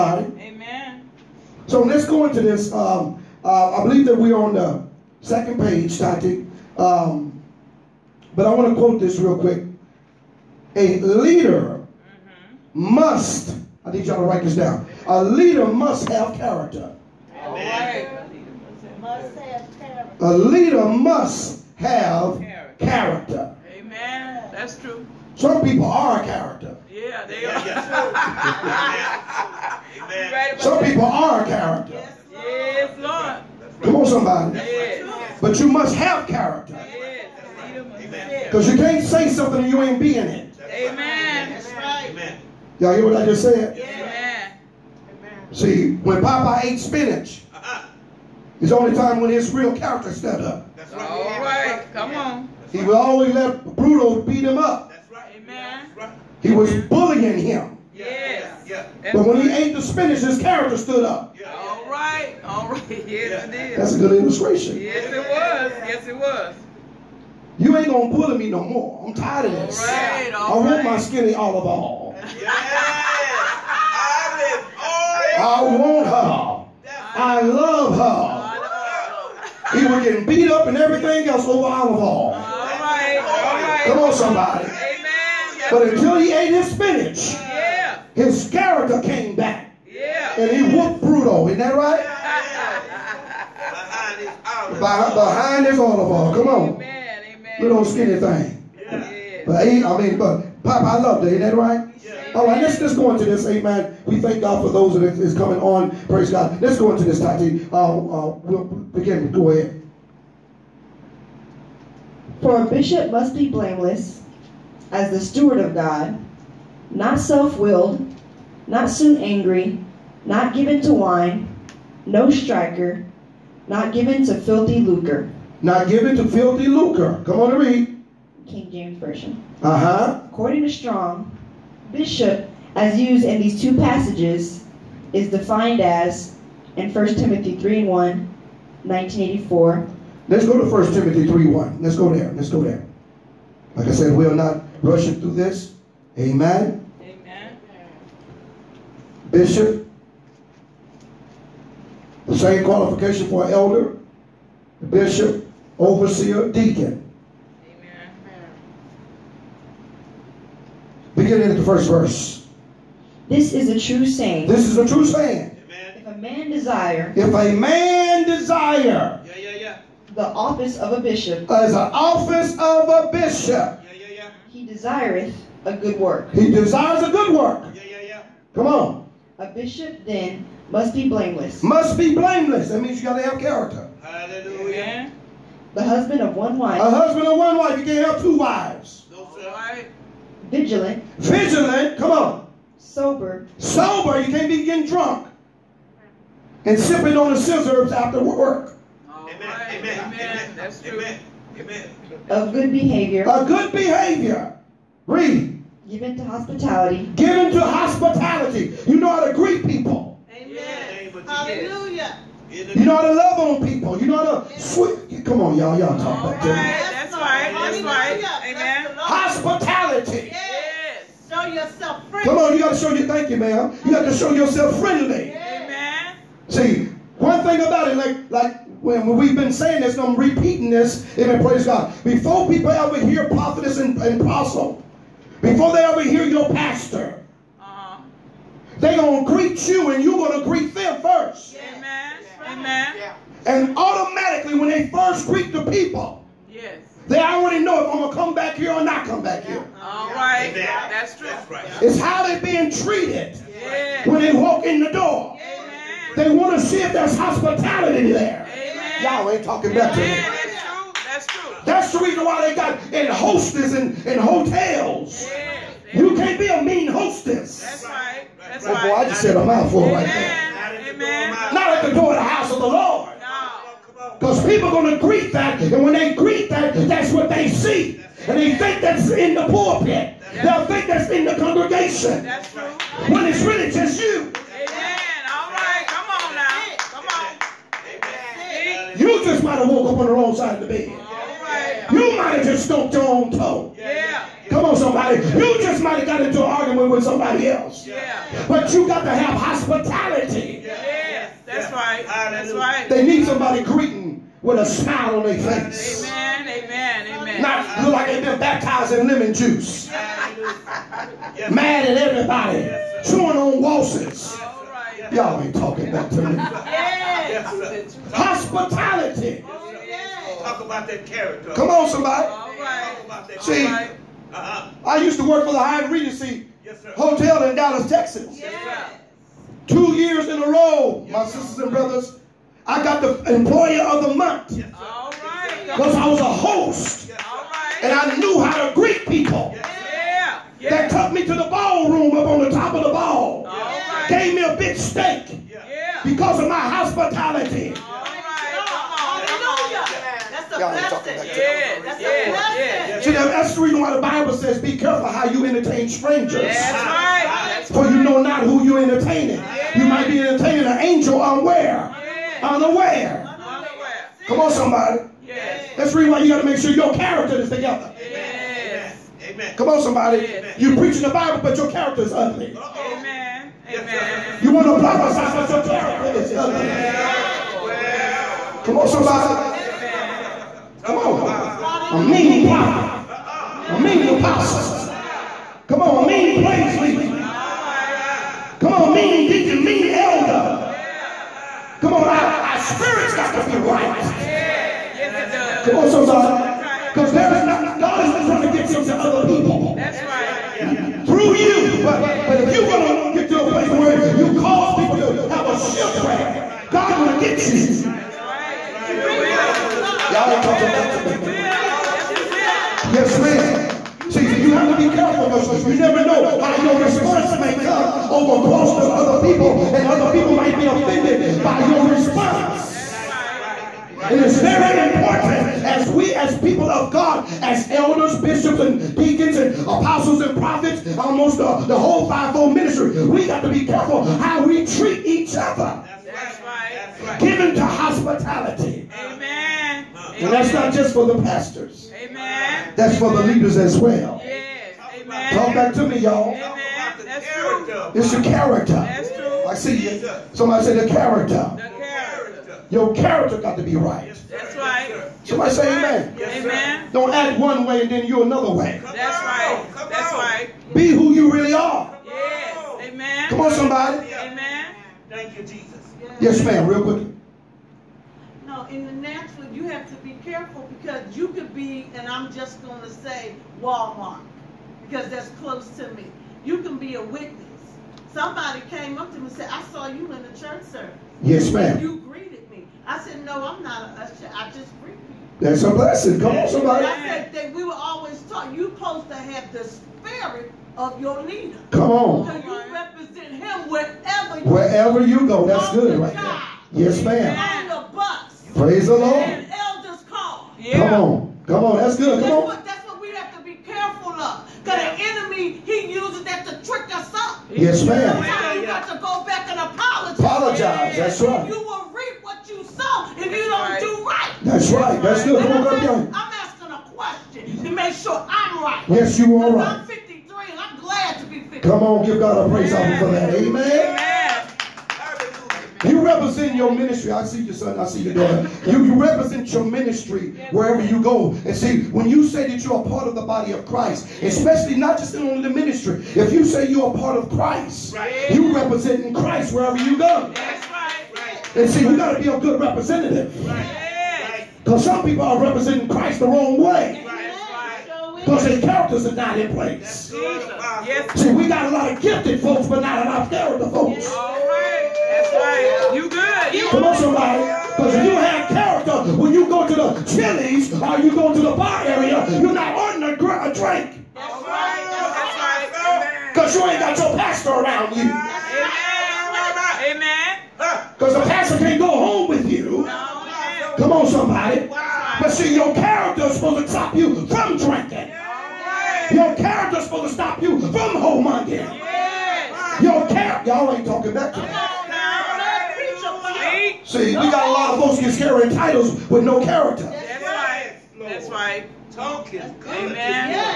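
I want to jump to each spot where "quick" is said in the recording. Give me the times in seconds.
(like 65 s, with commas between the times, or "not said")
9 s, 466 s.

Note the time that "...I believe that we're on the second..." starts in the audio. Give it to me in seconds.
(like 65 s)
3 s.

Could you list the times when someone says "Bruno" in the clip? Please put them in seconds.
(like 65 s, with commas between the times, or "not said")
53 s.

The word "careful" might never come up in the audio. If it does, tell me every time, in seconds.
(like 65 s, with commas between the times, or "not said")
354 s, 414 s, 433 s, 470 s, 503 s.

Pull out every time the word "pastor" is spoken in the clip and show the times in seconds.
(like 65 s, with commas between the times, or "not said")
236 s, 441 s, 567 s, 571 s.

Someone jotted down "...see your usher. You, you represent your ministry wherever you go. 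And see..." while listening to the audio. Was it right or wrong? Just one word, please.
wrong.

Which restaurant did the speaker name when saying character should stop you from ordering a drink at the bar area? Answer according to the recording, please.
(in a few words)
Chili's.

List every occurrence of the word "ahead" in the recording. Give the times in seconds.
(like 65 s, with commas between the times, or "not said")
109 s.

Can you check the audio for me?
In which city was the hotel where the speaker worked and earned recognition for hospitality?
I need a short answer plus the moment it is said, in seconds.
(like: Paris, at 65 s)
Dallas, at 327 s.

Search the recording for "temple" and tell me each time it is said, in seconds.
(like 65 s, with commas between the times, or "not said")
not said.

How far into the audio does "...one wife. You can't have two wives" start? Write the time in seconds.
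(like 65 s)
187 s.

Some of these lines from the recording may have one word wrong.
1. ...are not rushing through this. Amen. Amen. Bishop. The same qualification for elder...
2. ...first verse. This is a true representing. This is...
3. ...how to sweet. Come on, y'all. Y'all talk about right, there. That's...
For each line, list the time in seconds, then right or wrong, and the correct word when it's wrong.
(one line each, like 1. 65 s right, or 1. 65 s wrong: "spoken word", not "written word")
1. 144 s right
2. 161 s wrong: "saying", not "representing"
3. 214 s right.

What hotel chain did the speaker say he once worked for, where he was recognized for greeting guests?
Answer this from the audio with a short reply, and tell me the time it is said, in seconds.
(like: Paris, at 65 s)
Hyatt Regency, at 325 s.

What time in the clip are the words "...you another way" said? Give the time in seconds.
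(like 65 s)
458 s.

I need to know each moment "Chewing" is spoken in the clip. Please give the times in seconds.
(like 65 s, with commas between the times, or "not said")
313 s.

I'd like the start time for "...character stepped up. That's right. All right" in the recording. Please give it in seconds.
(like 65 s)
49 s.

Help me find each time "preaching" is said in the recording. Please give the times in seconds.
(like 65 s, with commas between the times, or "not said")
370 s.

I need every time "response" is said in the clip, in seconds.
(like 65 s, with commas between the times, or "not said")
416 s, 421 s.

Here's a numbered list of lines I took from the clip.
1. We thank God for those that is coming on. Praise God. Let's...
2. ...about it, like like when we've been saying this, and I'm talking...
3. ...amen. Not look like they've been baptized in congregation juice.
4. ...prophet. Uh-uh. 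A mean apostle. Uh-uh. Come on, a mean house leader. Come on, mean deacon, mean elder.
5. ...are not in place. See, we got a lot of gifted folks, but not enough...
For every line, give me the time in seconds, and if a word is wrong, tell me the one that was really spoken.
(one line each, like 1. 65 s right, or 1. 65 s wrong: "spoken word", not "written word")
1. 104 s right
2. 227 s wrong: "repeating", not "talking"
3. 307 s wrong: "lemon", not "congregation"
4. 382 s wrong: "praise", not "house"
5. 549 s right.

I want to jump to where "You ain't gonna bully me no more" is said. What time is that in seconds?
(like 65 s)
67 s.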